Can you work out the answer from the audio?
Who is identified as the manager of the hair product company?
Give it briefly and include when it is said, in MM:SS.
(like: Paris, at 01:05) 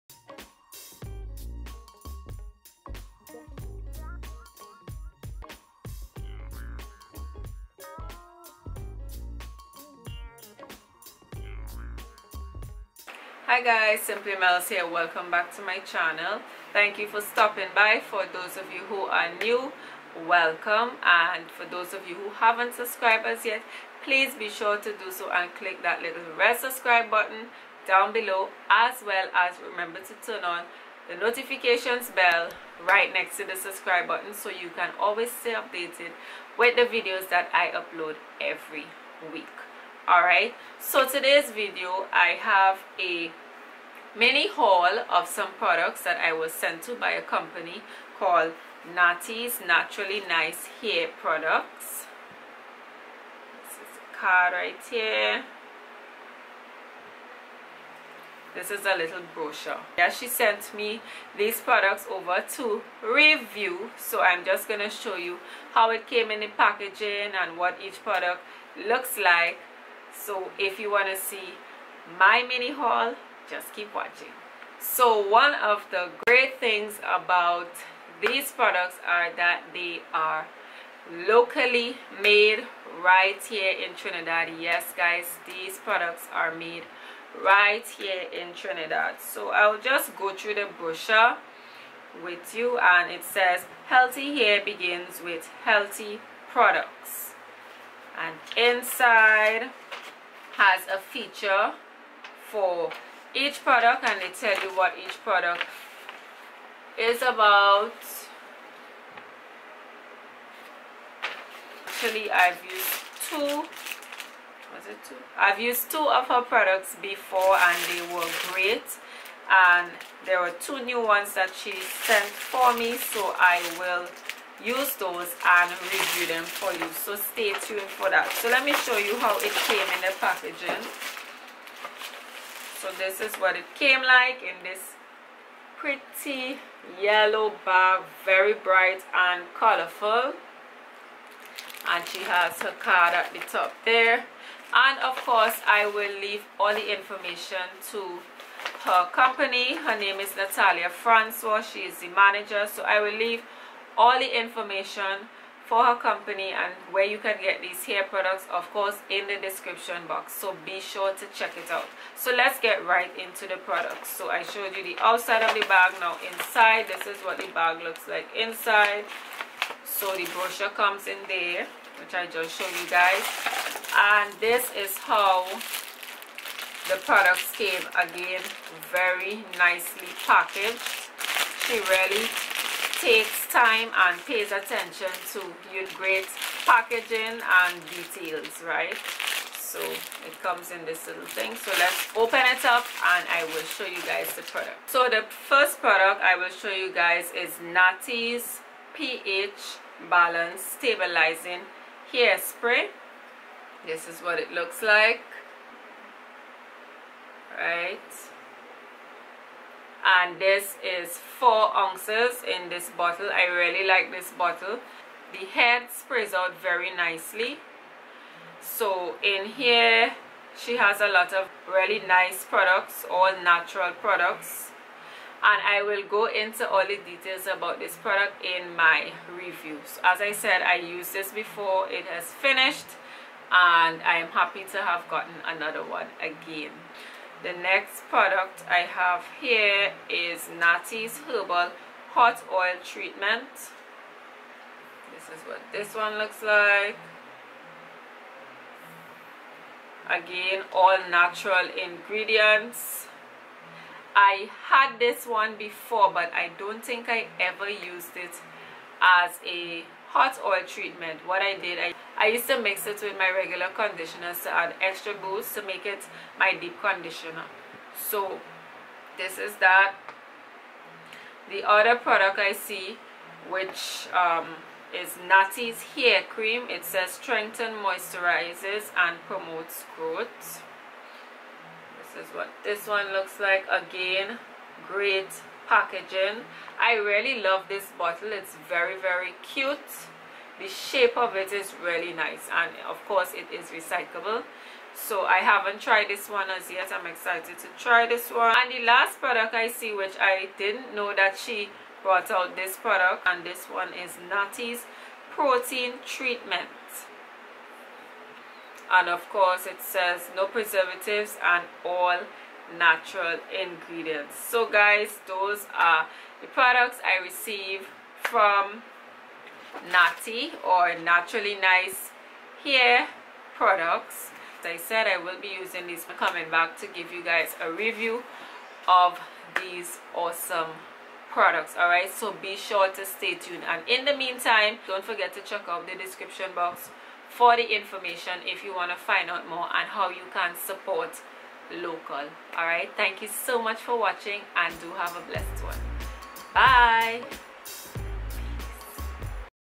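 Natalia Francois, at 02:30.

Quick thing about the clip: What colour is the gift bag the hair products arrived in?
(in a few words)
Yellow.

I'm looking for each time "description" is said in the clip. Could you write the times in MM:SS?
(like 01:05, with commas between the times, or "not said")
02:39, 05:36.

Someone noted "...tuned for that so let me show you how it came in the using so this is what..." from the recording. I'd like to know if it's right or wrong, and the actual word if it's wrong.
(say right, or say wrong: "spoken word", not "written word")
wrong: "packaging", not "using".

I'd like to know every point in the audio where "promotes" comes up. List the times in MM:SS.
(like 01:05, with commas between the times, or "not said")
04:39.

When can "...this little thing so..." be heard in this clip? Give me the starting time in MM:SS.
03:10.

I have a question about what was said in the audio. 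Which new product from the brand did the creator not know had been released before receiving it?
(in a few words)
Protein treatment.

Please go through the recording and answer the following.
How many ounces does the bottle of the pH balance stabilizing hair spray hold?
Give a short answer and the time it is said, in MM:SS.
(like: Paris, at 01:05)
4 ounces, at 03:31.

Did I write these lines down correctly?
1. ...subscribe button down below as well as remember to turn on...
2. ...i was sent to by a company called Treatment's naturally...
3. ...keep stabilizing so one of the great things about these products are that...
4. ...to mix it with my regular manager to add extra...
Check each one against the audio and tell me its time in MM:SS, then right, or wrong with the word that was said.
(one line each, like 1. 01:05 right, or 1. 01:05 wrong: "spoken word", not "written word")
1. 00:26 right
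2. 00:46 wrong: "Naty", not "Treatment"
3. 01:13 wrong: "watching", not "stabilizing"
4. 04:22 wrong: "conditioner", not "manager".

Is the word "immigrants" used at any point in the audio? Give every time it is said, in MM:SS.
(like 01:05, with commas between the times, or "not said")
not said.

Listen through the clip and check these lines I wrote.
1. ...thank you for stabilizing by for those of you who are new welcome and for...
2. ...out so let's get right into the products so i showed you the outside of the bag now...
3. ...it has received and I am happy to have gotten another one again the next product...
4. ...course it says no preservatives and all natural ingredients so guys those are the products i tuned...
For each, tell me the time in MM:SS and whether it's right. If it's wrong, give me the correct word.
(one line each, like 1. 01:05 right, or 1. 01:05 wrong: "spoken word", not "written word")
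1. 00:16 wrong: "stopping", not "stabilizing"
2. 02:41 right
3. 03:51 wrong: "finished", not "received"
4. 05:09 wrong: "received", not "tuned".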